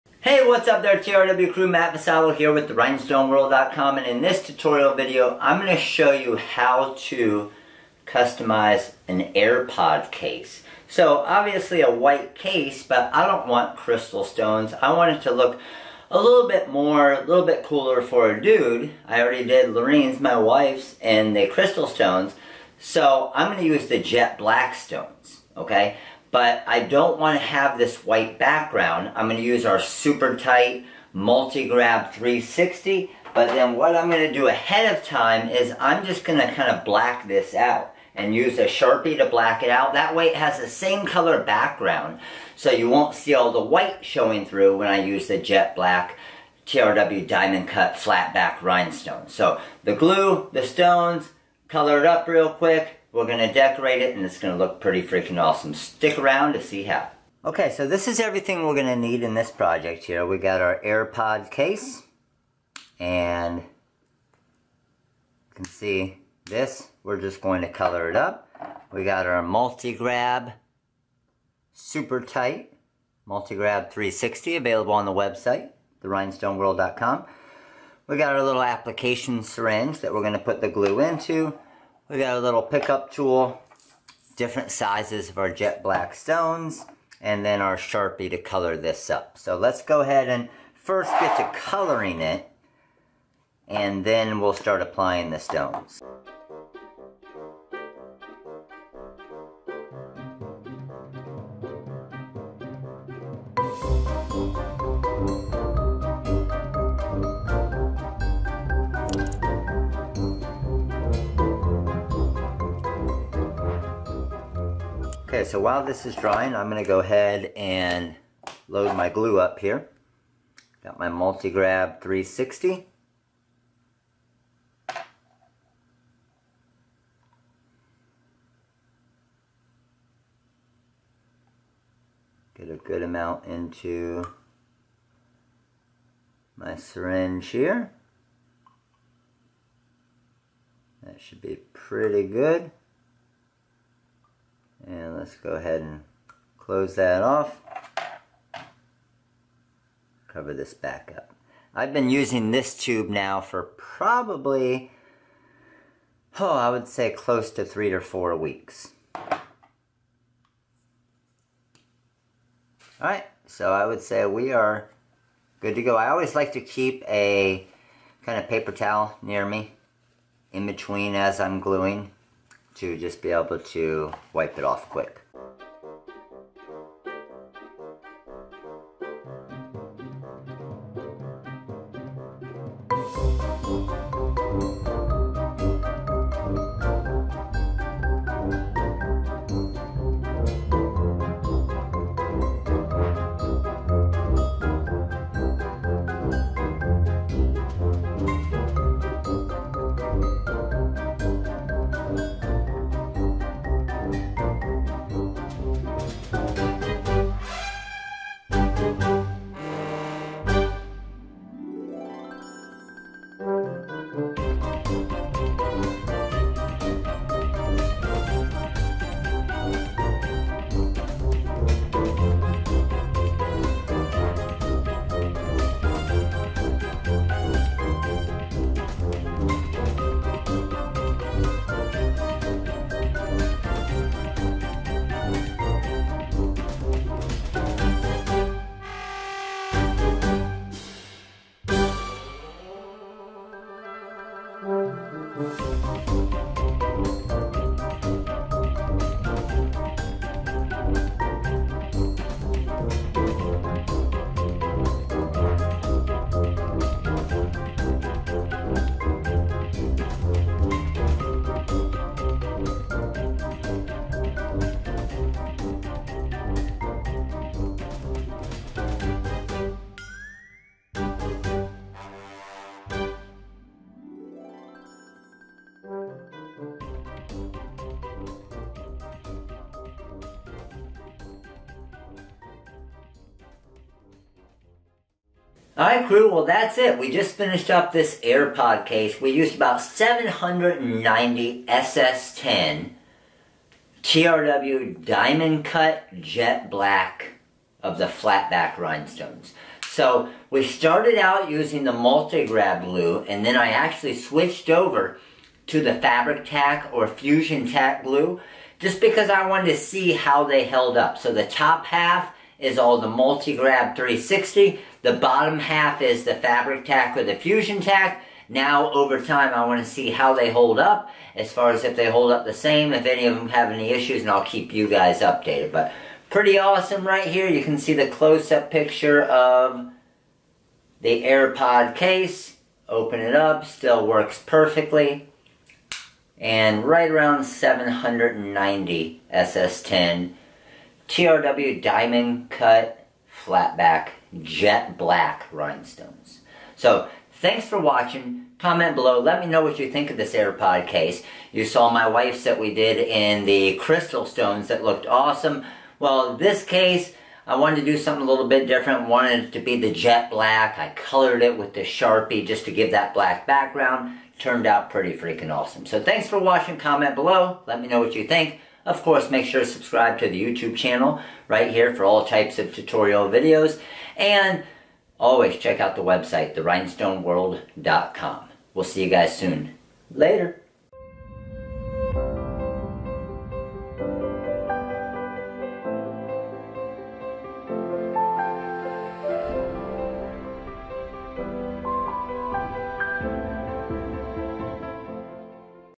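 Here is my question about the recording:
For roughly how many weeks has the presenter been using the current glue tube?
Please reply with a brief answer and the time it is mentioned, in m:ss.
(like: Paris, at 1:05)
3 to 4 weeks, at 2:37.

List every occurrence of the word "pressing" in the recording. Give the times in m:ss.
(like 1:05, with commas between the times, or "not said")
not said.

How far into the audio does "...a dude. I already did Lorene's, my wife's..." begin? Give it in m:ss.
0:18.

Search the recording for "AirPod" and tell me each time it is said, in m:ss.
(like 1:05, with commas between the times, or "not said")
0:09, 1:00, 4:48, 5:31, 5:50.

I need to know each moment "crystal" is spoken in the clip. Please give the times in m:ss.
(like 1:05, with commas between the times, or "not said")
0:13, 0:21, 5:53.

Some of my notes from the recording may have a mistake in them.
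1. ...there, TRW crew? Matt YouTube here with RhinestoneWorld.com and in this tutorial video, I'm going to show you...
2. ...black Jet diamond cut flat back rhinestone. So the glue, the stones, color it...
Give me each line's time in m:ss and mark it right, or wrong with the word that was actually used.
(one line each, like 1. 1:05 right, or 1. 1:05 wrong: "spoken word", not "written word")
1. 0:00 wrong: "Vassallo", not "YouTube"
2. 0:45 wrong: "TRW", not "Jet".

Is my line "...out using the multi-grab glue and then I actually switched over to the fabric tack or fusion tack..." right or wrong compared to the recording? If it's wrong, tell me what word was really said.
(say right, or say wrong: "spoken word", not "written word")
right.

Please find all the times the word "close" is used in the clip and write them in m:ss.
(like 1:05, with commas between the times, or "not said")
2:26, 2:37, 5:28.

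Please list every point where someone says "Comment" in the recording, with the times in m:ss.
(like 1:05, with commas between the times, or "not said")
5:48, 6:06.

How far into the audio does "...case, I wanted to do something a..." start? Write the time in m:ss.
5:56.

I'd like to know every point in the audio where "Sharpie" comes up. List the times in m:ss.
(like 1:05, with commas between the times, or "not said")
0:38, 1:27, 6:01.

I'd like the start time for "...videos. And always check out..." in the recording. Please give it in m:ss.
6:13.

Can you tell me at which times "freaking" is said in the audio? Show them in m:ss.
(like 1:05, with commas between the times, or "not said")
0:55, 6:05.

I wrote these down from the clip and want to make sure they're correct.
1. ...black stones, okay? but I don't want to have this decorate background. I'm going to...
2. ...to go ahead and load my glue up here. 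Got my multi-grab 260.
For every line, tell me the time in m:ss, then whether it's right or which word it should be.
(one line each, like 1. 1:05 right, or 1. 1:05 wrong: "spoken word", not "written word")
1. 0:24 wrong: "white", not "decorate"
2. 1:56 wrong: "360", not "260".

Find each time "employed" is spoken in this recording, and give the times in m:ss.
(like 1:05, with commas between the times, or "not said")
not said.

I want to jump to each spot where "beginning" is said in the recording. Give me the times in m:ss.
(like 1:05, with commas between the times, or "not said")
not said.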